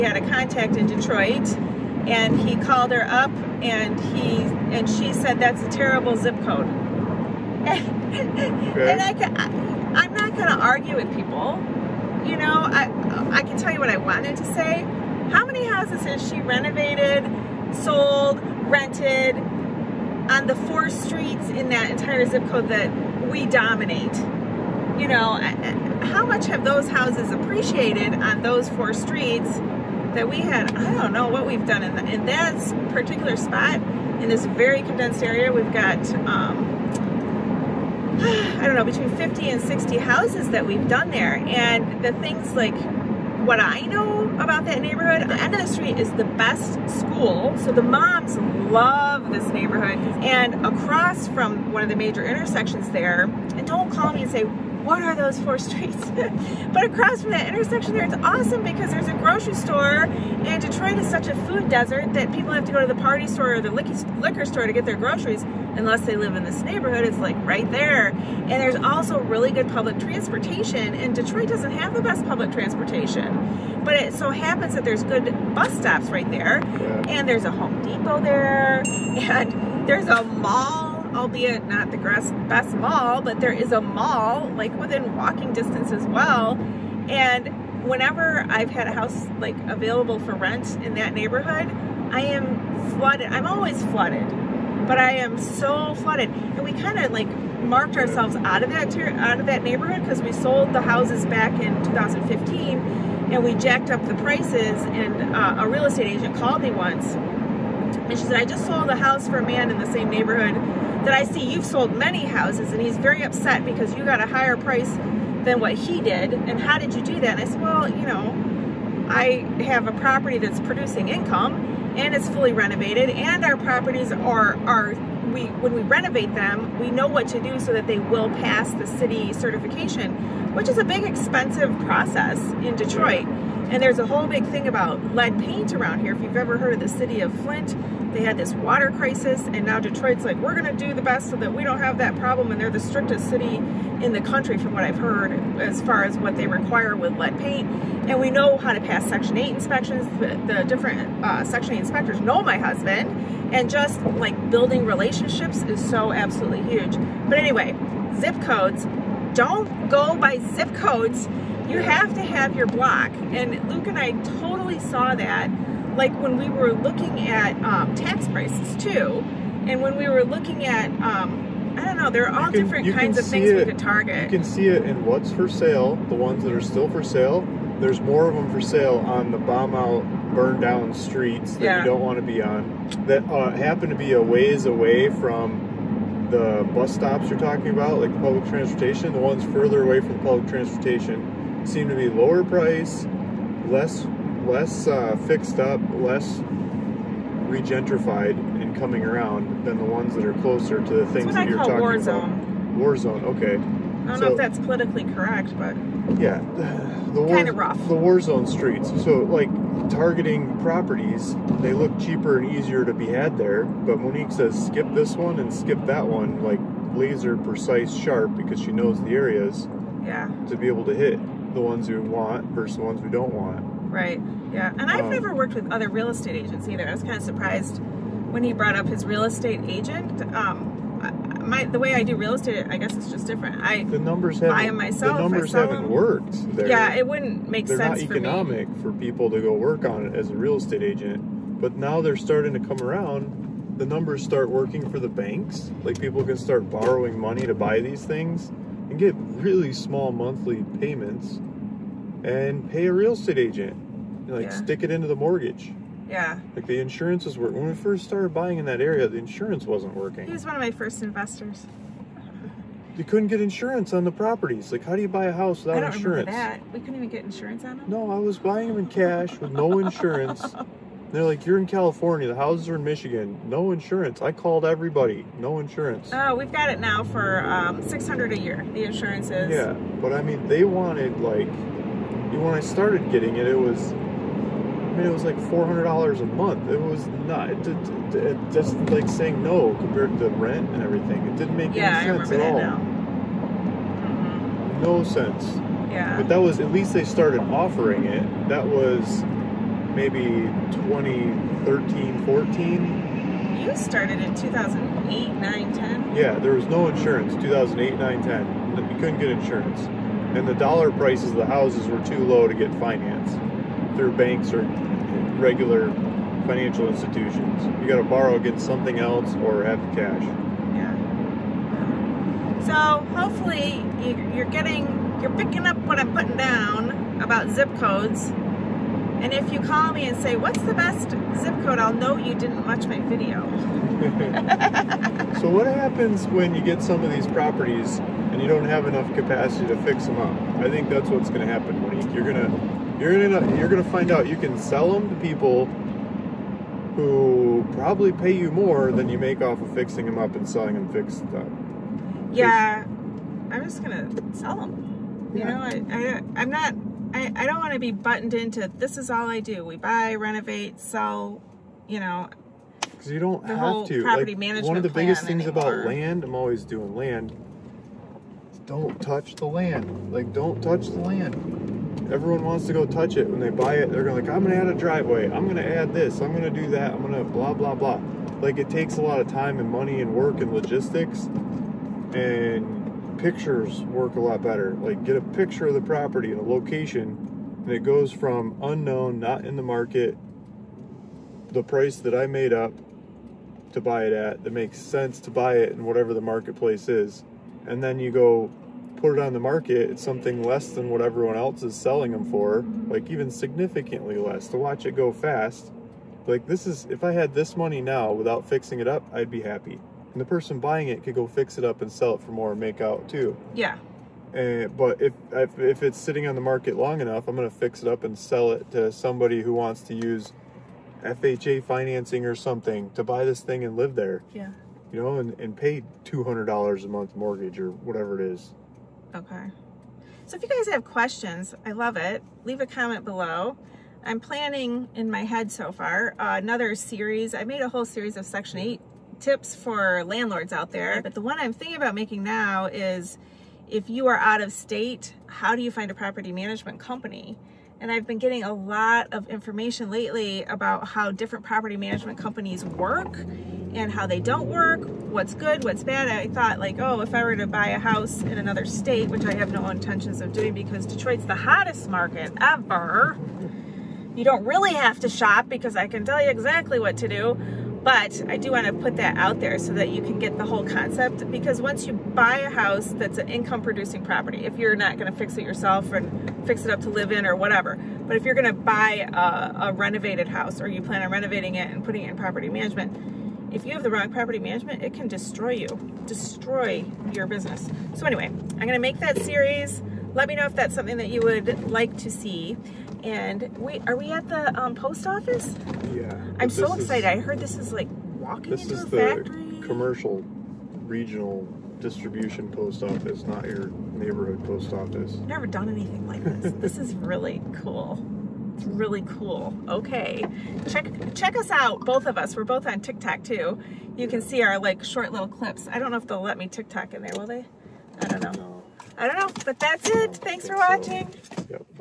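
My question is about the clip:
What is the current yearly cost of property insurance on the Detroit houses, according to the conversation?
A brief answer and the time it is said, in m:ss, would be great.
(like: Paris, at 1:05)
$600, at 4:37.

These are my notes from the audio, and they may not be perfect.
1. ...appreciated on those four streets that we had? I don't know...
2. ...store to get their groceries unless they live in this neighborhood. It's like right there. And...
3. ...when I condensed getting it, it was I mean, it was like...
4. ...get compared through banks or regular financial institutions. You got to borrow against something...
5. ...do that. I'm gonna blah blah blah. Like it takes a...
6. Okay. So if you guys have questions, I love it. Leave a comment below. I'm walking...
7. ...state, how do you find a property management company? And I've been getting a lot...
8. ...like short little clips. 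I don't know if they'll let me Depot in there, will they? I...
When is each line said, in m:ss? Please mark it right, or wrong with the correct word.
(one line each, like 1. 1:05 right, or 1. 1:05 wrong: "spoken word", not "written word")
1. 0:27 right
2. 1:04 right
3. 4:42 wrong: "started", not "condensed"
4. 5:12 wrong: "financed", not "compared"
5. 6:16 right
6. 7:09 wrong: "planning", not "walking"
7. 7:24 right
8. 8:34 wrong: "TikTok", not "Depot".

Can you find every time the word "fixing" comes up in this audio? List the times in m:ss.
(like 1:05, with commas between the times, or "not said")
5:49, 6:48.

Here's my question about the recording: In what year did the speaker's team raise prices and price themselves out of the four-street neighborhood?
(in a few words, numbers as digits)
2015.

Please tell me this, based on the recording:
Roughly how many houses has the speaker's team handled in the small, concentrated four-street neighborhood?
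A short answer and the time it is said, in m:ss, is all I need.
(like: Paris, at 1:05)
50 and 60, at 0:38.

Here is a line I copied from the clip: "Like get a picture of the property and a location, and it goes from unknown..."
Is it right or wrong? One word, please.
right.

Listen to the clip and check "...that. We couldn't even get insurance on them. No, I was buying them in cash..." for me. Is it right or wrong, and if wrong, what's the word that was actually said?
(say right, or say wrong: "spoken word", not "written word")
right.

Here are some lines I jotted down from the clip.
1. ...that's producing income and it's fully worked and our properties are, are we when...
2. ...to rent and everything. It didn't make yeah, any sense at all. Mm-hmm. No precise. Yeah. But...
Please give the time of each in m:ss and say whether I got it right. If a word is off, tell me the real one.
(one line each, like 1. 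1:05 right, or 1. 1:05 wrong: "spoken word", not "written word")
1. 2:00 wrong: "renovated", not "worked"
2. 4:50 wrong: "sense", not "precise".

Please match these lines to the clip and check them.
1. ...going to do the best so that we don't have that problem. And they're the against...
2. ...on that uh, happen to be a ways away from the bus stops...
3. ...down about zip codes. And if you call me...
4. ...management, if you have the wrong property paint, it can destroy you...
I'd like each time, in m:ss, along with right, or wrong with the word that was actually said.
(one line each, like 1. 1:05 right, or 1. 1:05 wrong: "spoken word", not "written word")
1. 2:20 wrong: "strictest", not "against"
2. 3:02 right
3. 5:26 right
4. 8:02 wrong: "management", not "paint".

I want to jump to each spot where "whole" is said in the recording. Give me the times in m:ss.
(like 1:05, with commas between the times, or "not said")
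2:14, 7:17, 7:50.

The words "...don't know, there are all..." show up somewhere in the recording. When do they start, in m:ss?
2:51.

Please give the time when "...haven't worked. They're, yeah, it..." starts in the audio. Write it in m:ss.
3:55.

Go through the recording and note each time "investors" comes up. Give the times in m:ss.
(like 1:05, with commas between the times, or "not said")
4:21.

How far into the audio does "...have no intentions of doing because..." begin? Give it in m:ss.
7:39.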